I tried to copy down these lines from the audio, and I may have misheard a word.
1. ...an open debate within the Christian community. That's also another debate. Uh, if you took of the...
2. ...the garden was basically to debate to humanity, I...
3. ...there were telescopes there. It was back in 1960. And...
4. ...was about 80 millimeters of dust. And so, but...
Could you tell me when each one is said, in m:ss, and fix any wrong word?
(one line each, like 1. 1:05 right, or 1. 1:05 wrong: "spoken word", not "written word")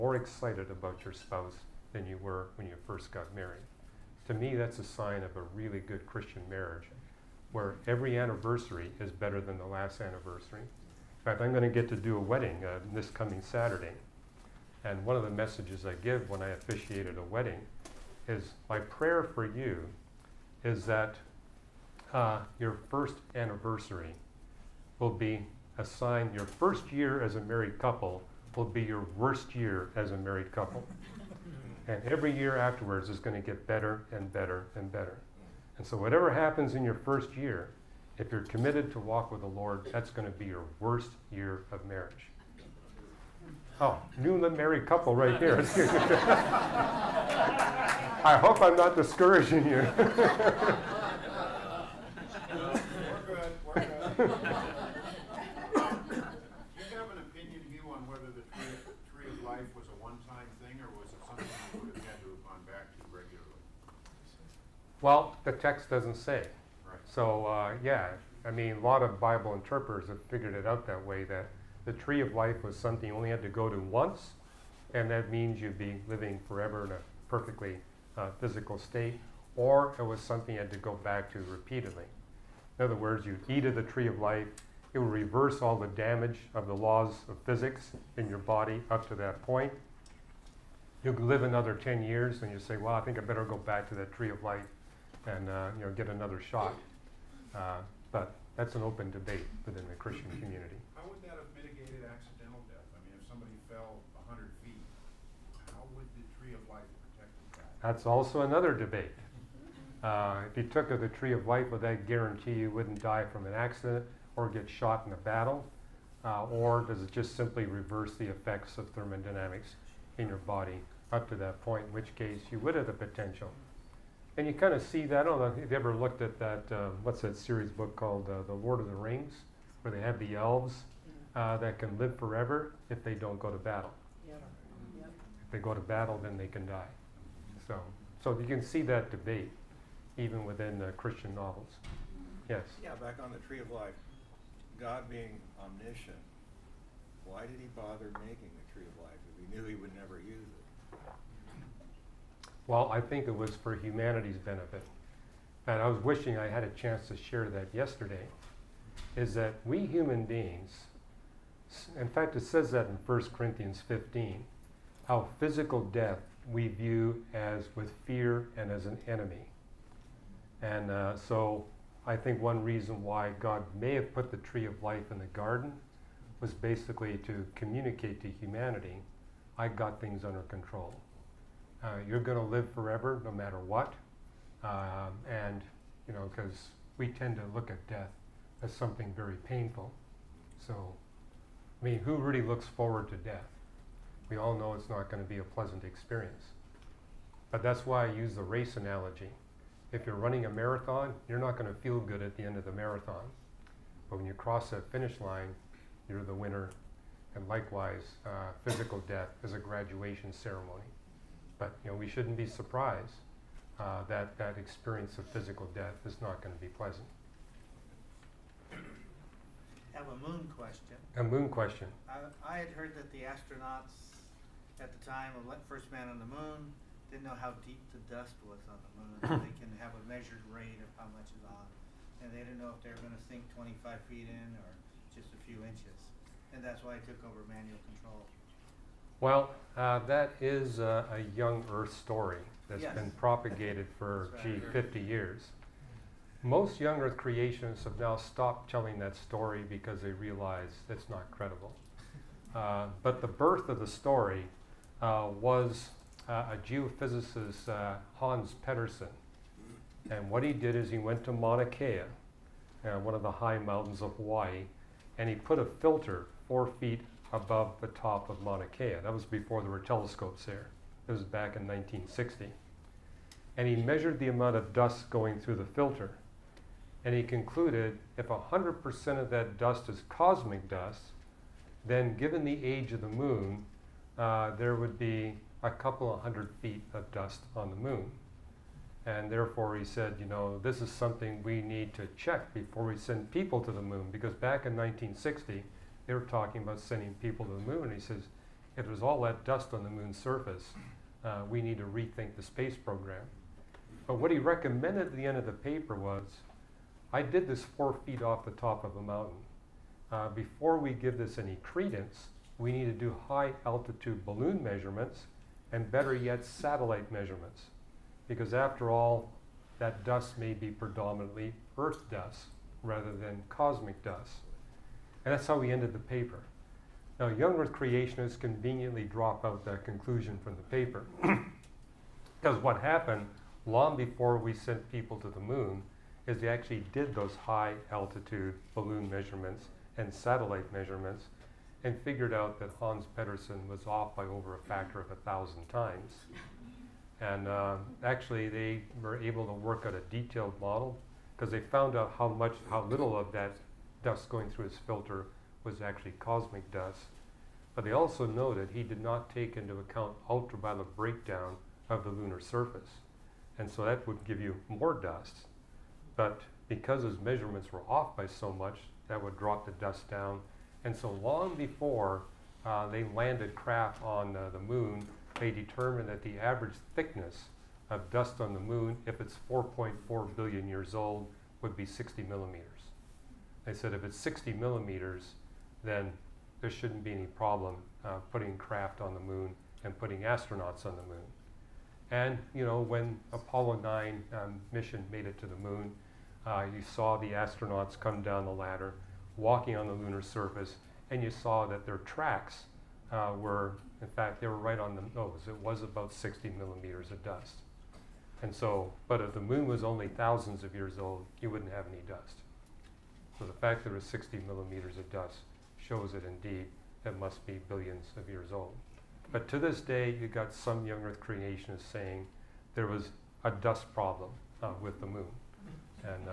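1. 1:38 right
2. 2:55 wrong: "communicate", not "debate"
3. 4:29 right
4. 6:45 wrong: "60", not "80".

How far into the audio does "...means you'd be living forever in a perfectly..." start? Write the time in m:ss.
1:15.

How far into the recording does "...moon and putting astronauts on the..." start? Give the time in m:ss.
6:29.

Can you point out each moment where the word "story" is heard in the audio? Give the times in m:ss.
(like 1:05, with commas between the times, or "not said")
4:01, 4:09, 4:13.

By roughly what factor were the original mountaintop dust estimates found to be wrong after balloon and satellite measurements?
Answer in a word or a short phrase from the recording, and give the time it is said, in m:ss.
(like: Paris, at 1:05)
over 1,000 times, at 5:44.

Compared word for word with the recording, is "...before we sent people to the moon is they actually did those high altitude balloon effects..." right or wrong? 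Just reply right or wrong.
wrong.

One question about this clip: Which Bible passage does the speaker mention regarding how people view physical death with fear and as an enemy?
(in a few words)
1 Corinthians 15.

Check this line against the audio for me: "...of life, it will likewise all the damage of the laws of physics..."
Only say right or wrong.
wrong.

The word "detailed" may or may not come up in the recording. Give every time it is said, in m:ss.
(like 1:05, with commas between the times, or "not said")
5:50.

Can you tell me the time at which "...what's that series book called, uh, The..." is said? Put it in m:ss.
2:07.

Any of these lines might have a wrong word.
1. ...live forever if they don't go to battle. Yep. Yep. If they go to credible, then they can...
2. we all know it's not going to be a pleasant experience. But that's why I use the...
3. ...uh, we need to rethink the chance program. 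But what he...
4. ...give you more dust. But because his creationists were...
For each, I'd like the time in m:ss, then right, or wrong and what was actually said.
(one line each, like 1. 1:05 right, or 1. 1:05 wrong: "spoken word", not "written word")
1. 2:11 wrong: "battle", not "credible"
2. 3:14 right
3. 5:01 wrong: "space", not "chance"
4. 6:04 wrong: "measurements", not "creationists".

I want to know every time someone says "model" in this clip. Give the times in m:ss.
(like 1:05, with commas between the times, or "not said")
5:50.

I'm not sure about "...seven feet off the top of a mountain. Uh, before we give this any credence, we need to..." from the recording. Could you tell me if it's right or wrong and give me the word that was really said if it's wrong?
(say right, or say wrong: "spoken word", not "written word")
wrong: "four", not "seven".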